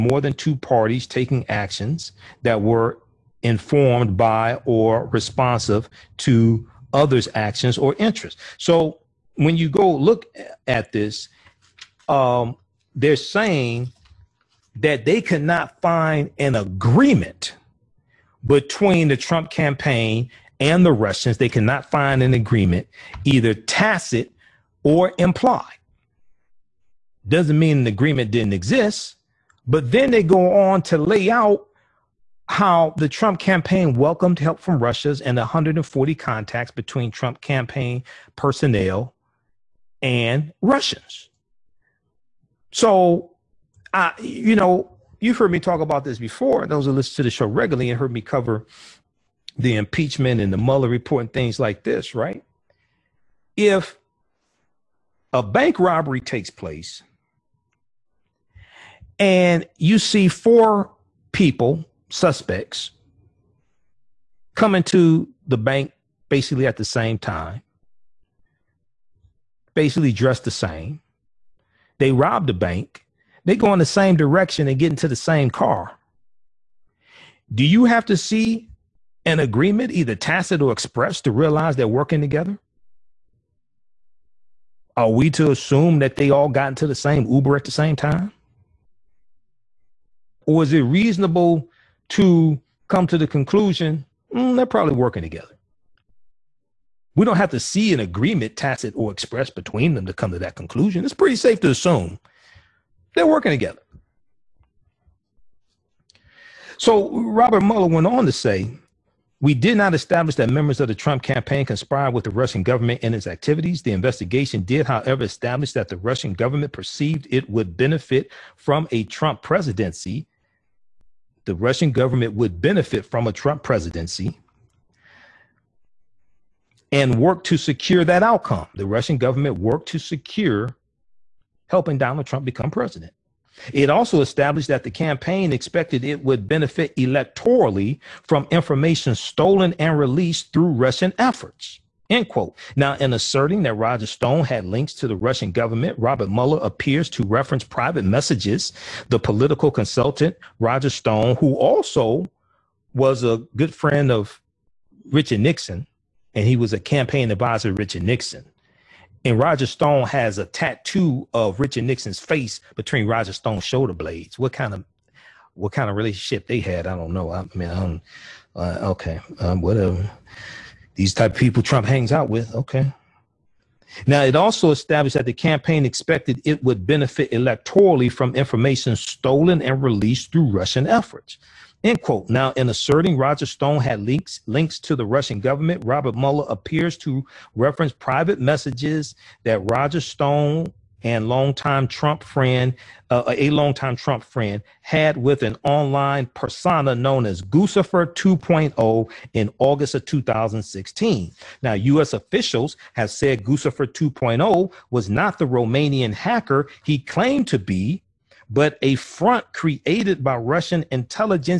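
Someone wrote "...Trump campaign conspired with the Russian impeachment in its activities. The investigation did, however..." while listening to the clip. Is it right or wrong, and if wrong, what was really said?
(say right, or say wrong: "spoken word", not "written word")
wrong: "government", not "impeachment".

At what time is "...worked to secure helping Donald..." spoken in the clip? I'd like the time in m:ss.
2:09.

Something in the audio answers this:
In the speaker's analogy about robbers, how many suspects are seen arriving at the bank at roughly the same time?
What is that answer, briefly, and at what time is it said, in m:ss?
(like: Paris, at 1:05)
4, at 1:00.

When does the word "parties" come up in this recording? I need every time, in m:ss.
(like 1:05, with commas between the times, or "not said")
0:00.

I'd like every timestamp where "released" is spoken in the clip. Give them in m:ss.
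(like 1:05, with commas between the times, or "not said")
2:19, 2:59.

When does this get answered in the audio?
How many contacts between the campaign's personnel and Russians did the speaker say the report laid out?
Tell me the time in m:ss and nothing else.
0:35.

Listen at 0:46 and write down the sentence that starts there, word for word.
Those who listen to the show regularly and heard me cover the impeachment and the Mueller report and things like this, right?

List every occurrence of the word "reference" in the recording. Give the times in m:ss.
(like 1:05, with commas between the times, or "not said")
2:27, 3:07.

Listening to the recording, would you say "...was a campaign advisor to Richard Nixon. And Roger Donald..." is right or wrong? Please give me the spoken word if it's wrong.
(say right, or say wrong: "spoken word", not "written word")
wrong: "Stone", not "Donald".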